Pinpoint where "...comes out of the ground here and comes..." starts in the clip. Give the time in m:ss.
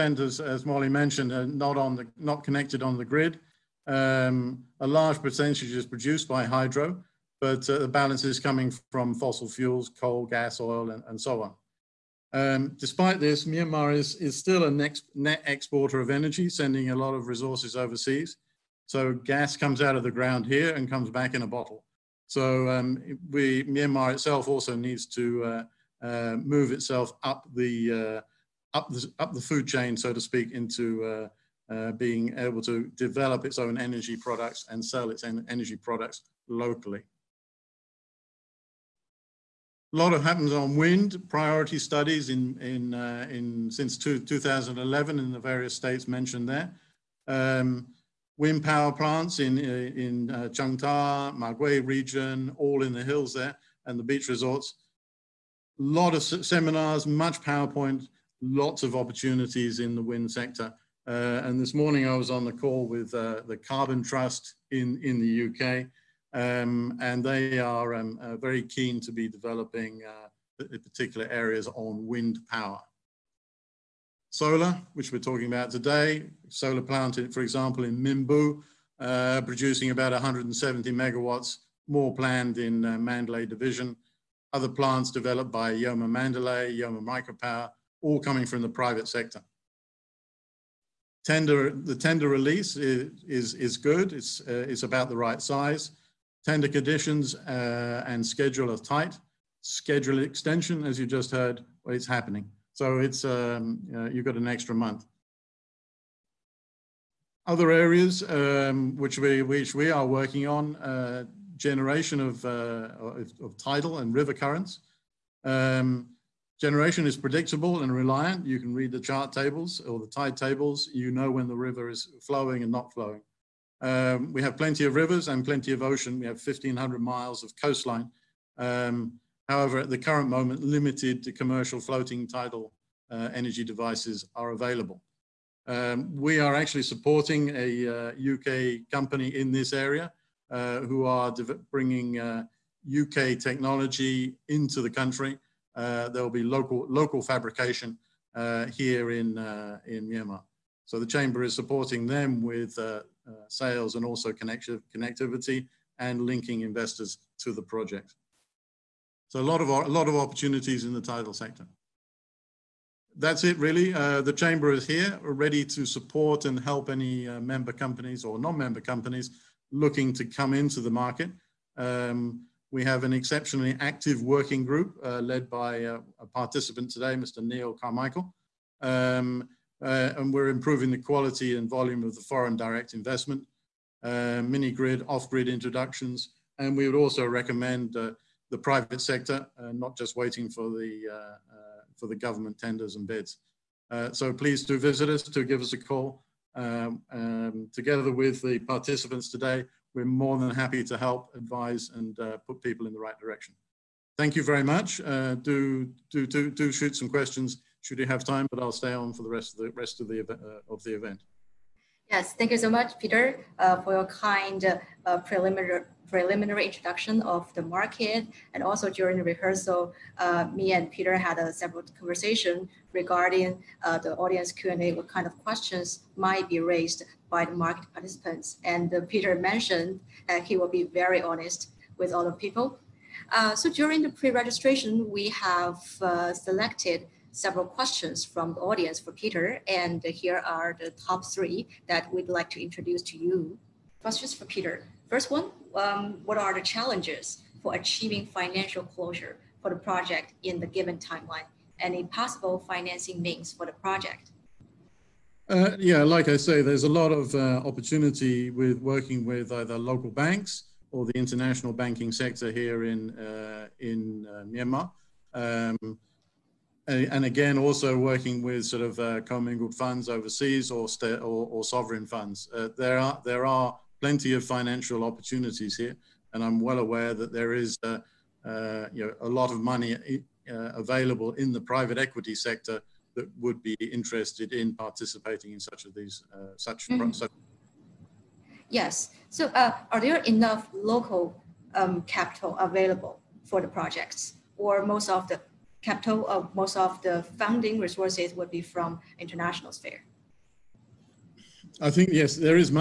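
0:19.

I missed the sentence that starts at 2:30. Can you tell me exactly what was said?
So the Chamber is supporting them with sales and also connectivity and linking investors to the project.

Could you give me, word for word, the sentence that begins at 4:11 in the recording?
Any possible financing means for the project?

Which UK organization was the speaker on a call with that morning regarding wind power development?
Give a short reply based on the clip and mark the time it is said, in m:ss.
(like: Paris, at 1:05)
Carbon Trust, at 1:03.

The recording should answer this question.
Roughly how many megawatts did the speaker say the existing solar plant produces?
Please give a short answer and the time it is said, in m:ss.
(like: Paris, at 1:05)
170 megawatts, at 1:20.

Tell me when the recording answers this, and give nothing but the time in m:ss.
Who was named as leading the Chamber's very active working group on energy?
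2:57.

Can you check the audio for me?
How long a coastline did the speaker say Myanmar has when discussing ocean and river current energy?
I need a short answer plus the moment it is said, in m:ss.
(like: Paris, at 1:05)
1,500 miles, at 2:06.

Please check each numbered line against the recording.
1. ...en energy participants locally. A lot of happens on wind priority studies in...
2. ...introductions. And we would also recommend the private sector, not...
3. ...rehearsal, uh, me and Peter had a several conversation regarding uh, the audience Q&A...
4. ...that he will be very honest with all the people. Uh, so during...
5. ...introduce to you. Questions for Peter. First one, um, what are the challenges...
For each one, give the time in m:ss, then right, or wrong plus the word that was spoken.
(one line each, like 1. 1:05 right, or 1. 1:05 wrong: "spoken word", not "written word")
1. 0:35 wrong: "products", not "participants"
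2. 3:05 right
3. 3:39 right
4. 3:50 right
5. 4:02 right.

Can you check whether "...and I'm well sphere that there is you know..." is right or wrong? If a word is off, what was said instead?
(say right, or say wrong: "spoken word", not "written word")
wrong: "aware", not "sphere".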